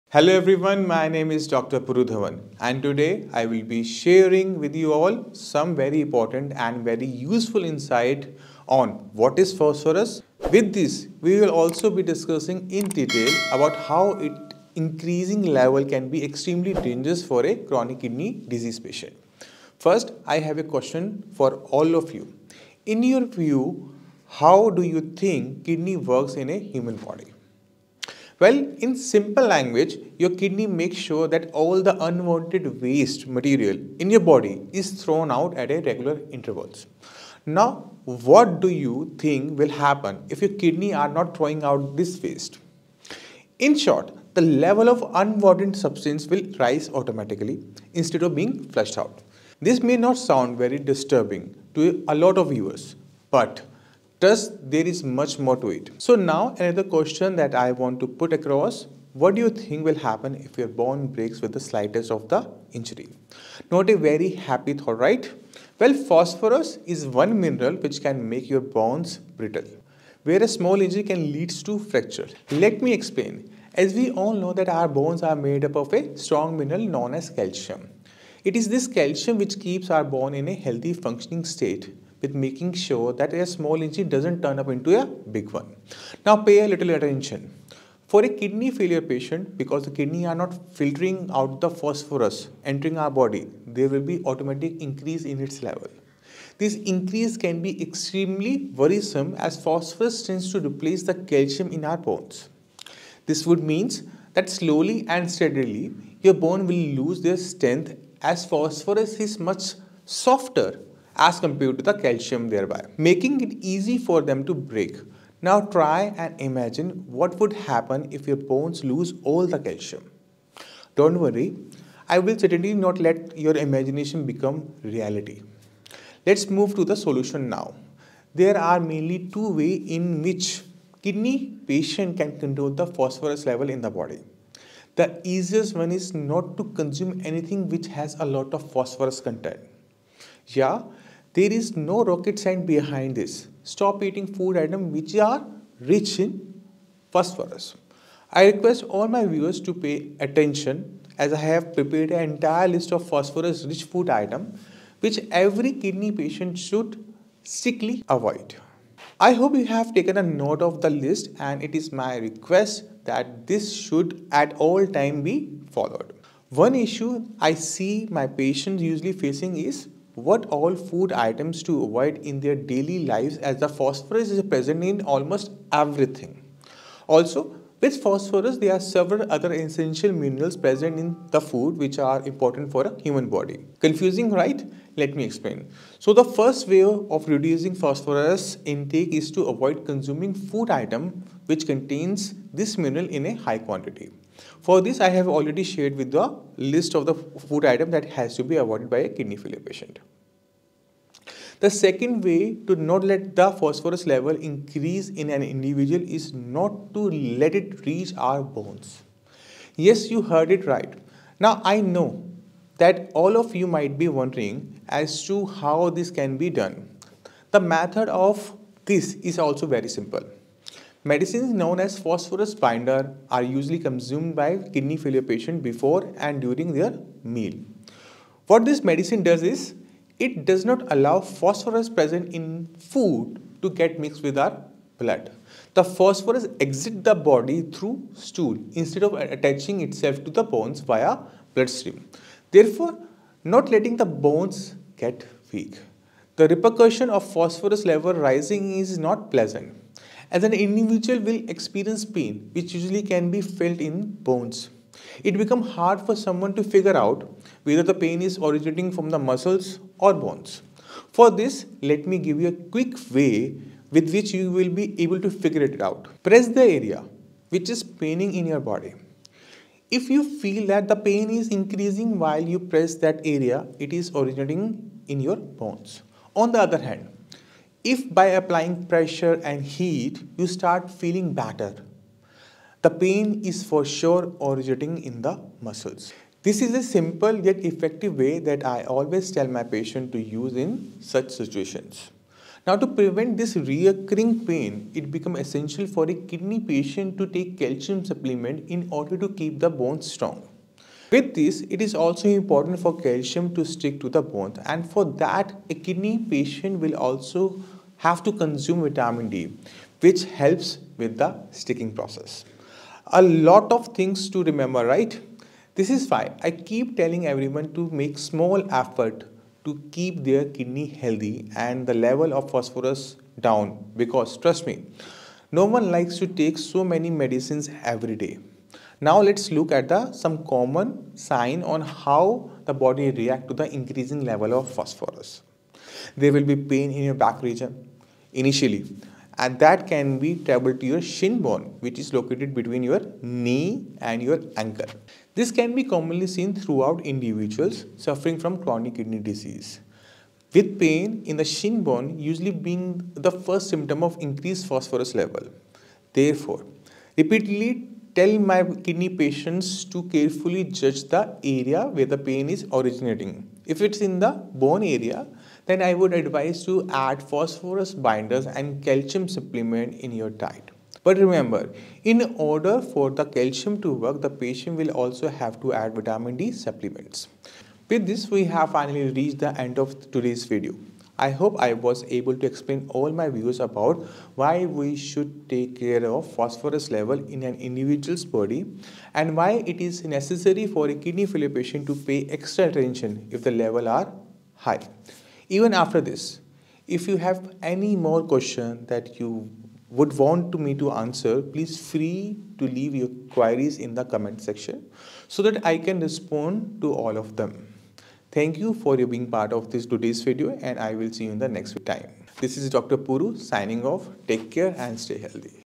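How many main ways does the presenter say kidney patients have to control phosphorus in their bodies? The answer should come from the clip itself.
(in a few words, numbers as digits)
2.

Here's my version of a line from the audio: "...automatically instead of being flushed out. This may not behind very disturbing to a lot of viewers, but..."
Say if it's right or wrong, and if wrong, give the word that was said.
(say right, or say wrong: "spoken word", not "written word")
wrong: "sound", not "behind".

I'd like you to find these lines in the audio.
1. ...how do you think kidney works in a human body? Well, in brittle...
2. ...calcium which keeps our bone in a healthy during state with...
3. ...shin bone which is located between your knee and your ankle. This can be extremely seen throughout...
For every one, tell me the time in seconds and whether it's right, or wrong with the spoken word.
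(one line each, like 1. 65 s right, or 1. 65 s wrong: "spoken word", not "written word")
1. 24 s wrong: "simple", not "brittle"
2. 78 s wrong: "functioning", not "during"
3. 341 s wrong: "commonly", not "extremely".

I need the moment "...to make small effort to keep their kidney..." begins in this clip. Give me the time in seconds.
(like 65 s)
317 s.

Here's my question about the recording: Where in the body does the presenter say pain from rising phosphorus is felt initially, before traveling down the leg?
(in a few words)
back region.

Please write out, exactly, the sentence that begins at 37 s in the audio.
Now, what do you think will happen if your kidney are not throwing out this waste?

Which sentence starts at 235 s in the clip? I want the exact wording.
The phosphorus exits the body through stool instead of attaching itself to the bones via bloodstream.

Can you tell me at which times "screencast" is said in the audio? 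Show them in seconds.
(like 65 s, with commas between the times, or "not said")
not said.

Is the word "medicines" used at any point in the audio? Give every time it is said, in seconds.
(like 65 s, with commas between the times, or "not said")
221 s, 228 s, 327 s.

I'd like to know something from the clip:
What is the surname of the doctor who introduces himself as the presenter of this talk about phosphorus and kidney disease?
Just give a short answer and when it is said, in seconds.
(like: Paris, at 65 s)
Dhawan, at 2 s.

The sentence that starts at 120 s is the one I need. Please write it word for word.
Don't worry, I will certainly not let your imagination become reality.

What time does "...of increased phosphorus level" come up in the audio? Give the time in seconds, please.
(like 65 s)
354 s.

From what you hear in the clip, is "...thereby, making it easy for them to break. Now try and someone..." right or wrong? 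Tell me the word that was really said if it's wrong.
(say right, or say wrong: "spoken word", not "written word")
wrong: "imagine", not "someone".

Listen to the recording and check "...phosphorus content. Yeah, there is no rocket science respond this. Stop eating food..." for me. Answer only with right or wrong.
wrong.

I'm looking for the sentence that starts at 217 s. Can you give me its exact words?
The method of this is also very simple.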